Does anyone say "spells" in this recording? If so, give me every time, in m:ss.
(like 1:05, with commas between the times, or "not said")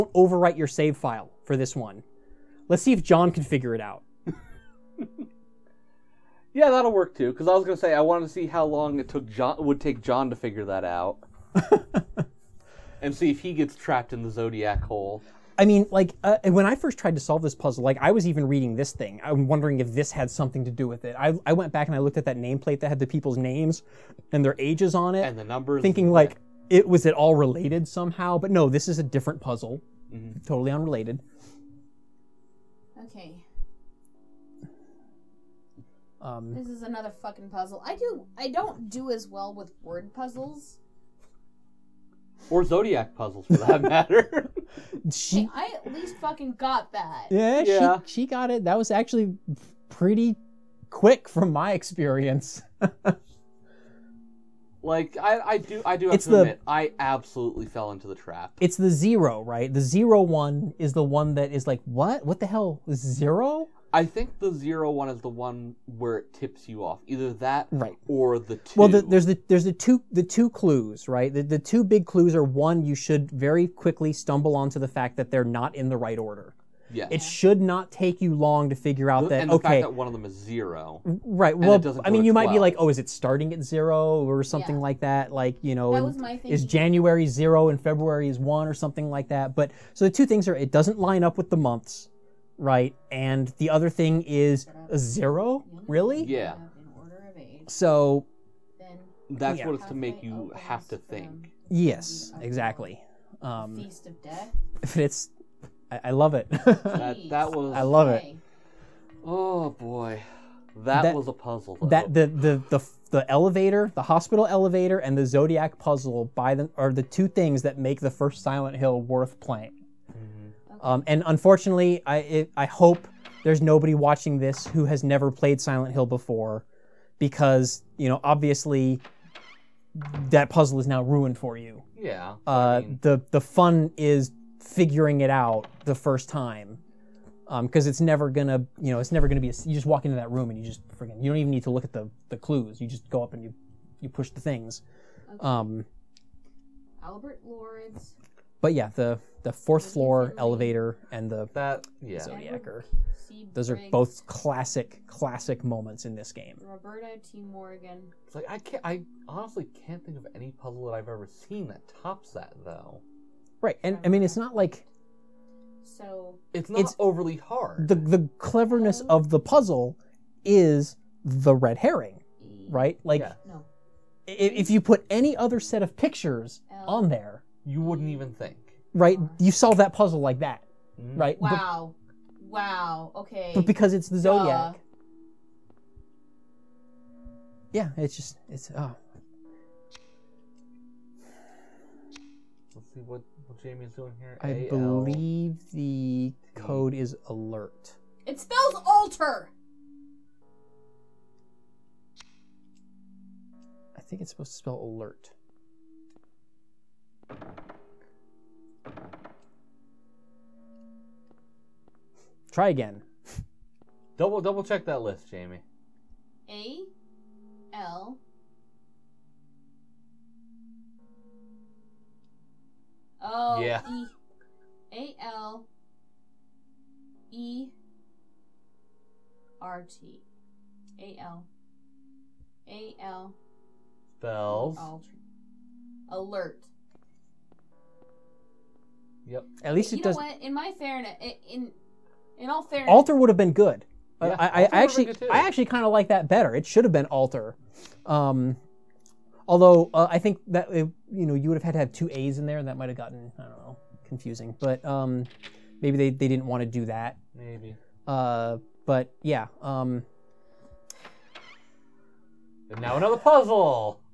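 3:18, 3:24, 3:54.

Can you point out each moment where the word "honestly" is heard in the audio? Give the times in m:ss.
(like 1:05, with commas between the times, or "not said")
2:39.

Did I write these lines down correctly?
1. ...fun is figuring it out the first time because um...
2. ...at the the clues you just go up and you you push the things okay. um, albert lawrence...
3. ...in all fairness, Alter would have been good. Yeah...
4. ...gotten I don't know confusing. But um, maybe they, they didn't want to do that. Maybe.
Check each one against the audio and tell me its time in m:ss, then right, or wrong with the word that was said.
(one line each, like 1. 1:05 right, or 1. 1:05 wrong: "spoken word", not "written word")
1. 2:13 right
2. 2:21 right
3. 4:02 right
4. 4:12 right.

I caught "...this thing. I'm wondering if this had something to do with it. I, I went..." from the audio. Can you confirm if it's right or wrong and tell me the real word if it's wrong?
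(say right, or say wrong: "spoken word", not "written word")
right.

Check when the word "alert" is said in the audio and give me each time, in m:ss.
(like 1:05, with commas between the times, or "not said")
3:17, 3:24, 3:56.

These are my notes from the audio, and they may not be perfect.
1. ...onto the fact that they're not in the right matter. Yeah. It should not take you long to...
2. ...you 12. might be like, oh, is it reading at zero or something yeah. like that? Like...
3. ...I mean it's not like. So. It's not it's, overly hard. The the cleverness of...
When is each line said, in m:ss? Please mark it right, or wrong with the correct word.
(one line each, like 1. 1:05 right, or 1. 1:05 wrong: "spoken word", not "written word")
1. 1:14 wrong: "order", not "matter"
2. 1:22 wrong: "starting", not "reading"
3. 2:44 right.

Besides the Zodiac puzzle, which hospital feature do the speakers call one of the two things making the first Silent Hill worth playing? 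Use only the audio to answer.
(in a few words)
The hospital elevator.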